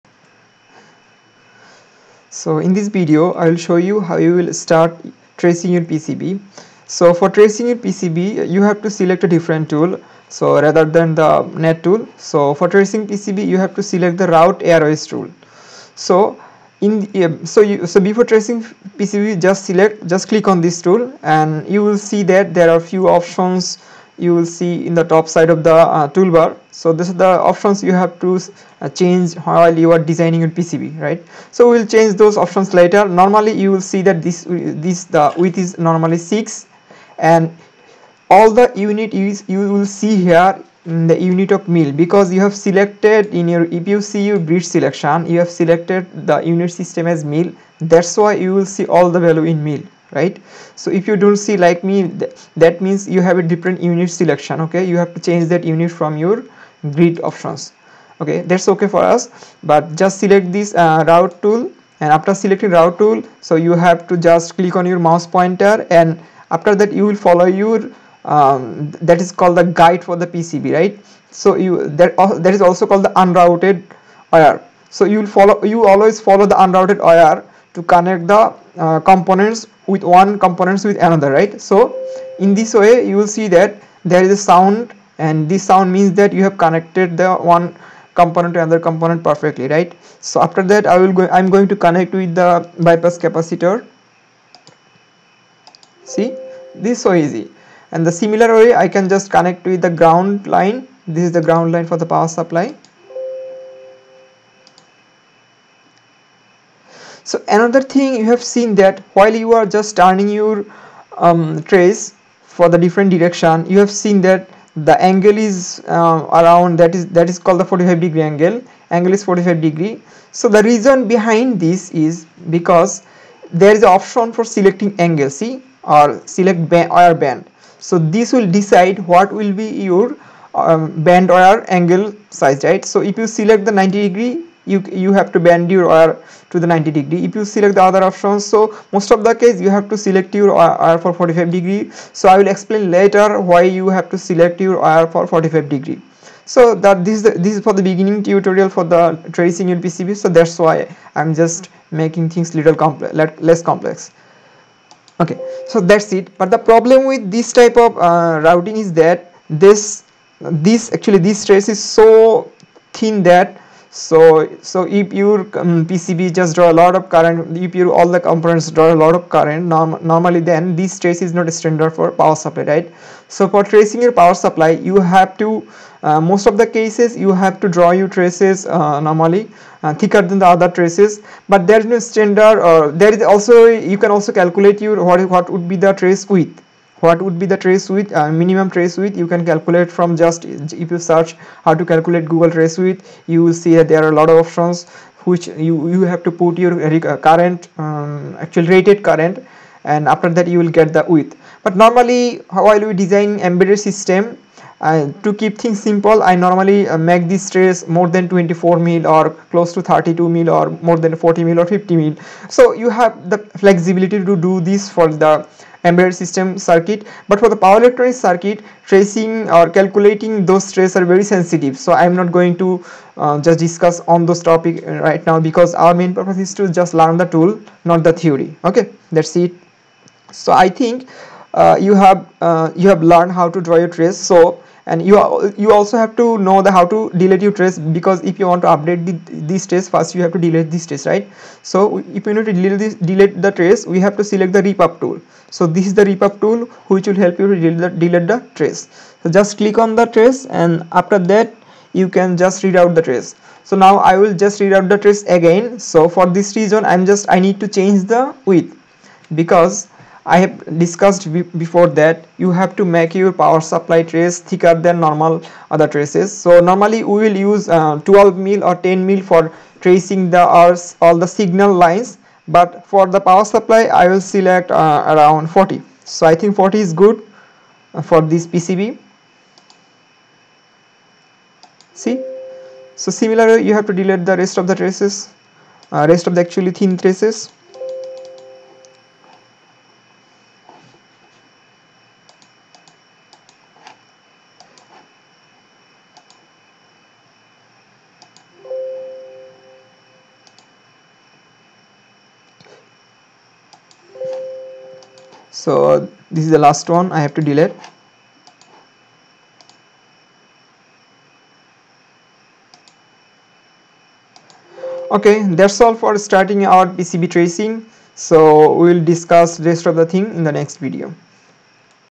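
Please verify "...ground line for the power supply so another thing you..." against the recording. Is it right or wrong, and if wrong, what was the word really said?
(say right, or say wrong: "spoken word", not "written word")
right.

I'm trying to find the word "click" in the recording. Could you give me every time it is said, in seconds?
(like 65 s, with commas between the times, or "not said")
20 s, 64 s, 249 s.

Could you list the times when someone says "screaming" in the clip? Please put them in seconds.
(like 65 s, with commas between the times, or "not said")
not said.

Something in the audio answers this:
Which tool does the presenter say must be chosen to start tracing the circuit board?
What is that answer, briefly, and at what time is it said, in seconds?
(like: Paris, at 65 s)
route airwires tool, at 14 s.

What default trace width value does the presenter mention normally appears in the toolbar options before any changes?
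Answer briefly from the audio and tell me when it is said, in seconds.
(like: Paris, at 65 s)
6, at 35 s.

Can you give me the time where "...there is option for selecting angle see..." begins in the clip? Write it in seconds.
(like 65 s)
123 s.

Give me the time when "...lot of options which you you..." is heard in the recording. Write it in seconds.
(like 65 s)
194 s.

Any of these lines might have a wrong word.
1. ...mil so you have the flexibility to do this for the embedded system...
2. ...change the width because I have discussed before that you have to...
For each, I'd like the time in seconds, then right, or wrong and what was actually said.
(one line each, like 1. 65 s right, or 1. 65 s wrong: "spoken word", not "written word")
1. 211 s right
2. 257 s right.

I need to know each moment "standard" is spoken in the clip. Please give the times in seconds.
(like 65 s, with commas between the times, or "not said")
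171 s, 181 s.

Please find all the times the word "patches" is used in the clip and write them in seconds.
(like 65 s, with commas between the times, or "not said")
not said.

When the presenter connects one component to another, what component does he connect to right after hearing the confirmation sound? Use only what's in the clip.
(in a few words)
bypass capacitor.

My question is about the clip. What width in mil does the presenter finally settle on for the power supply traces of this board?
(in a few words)
40.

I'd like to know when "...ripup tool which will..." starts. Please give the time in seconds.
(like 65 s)
246 s.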